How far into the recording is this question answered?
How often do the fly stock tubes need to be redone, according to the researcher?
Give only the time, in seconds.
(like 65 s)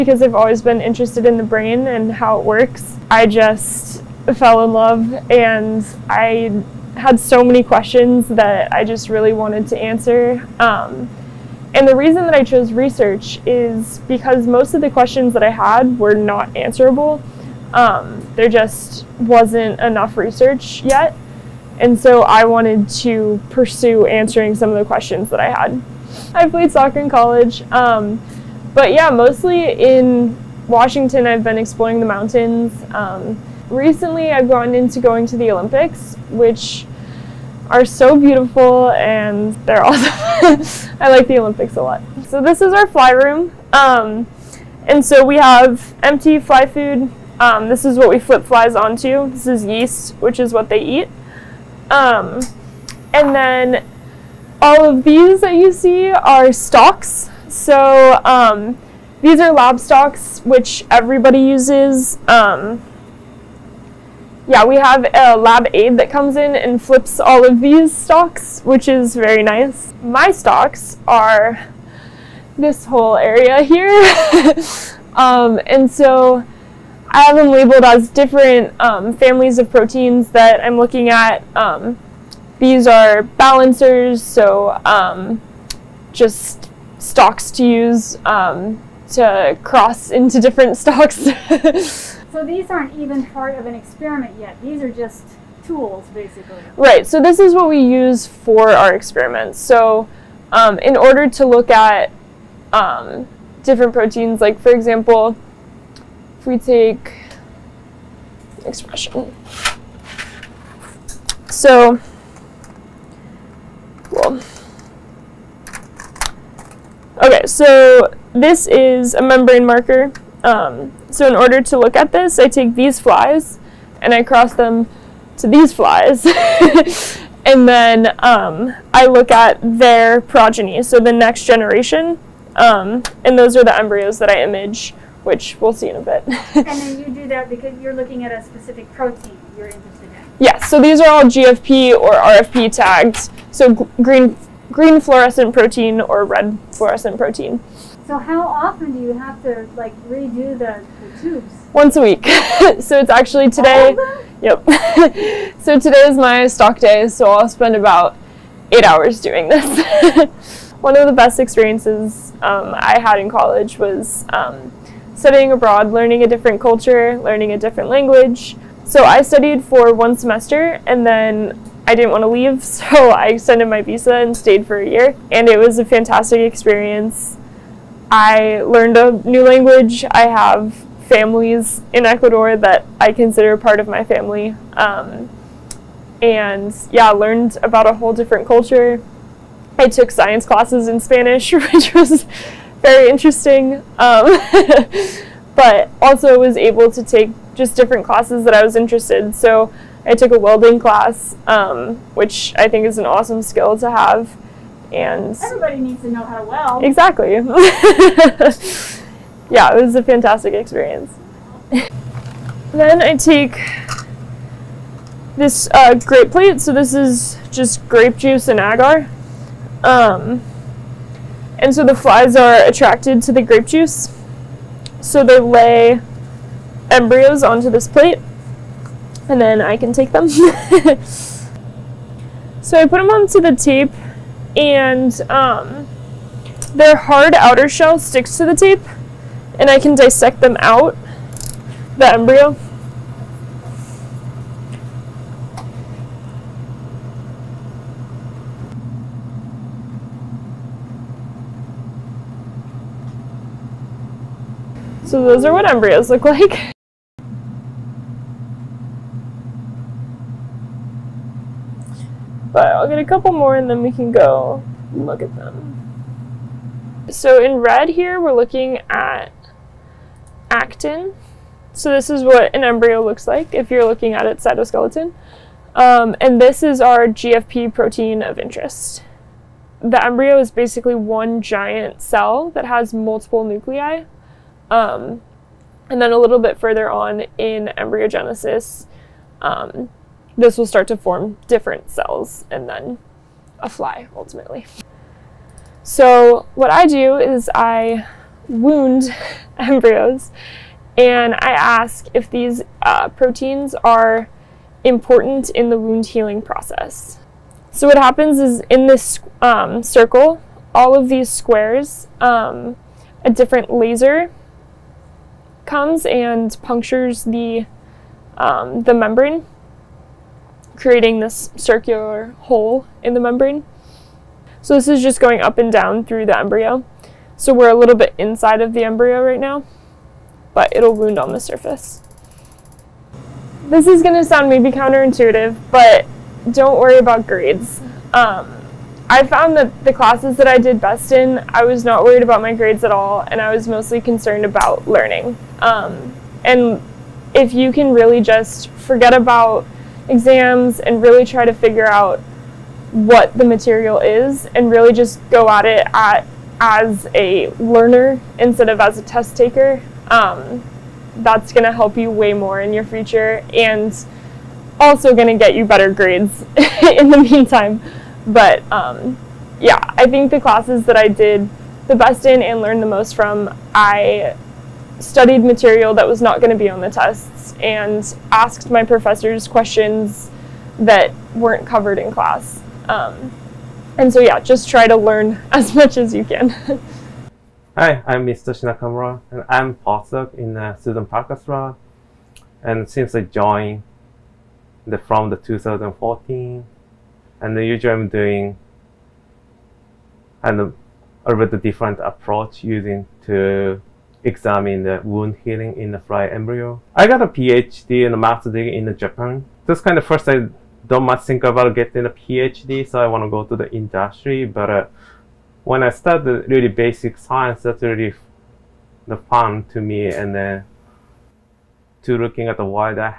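151 s.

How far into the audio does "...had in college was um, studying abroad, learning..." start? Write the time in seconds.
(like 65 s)
163 s.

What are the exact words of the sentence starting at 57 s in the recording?
So um, these are lab stocks, which everybody uses.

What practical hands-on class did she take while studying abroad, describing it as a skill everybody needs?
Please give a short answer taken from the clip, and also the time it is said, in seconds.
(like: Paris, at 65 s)
Welding, at 200 s.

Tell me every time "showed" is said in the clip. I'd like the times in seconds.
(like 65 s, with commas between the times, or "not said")
not said.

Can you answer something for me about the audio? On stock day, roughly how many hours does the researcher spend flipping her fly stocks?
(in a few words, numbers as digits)
8.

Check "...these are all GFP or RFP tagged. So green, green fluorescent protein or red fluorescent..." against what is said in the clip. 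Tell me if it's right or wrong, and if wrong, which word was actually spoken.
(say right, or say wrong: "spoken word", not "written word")
right.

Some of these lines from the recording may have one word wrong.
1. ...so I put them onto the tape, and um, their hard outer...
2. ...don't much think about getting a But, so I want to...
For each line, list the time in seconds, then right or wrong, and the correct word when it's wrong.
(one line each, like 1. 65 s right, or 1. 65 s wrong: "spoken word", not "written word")
1. 230 s right
2. 410 s wrong: "PhD", not "But".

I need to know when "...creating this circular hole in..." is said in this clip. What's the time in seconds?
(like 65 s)
320 s.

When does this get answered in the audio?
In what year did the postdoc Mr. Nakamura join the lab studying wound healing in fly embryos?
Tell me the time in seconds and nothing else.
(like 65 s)
395 s.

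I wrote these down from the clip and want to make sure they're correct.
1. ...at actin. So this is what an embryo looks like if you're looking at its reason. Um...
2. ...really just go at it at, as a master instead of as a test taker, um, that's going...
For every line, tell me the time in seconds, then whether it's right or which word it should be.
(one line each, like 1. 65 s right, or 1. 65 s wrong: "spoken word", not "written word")
1. 268 s wrong: "cytoskeleton", not "reason"
2. 354 s wrong: "learner", not "master".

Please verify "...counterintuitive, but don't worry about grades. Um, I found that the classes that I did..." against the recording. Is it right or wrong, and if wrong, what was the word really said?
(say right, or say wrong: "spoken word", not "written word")
right.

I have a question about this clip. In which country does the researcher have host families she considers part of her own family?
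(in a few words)
Ecuador.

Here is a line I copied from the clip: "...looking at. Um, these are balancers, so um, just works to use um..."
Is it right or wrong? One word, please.
wrong.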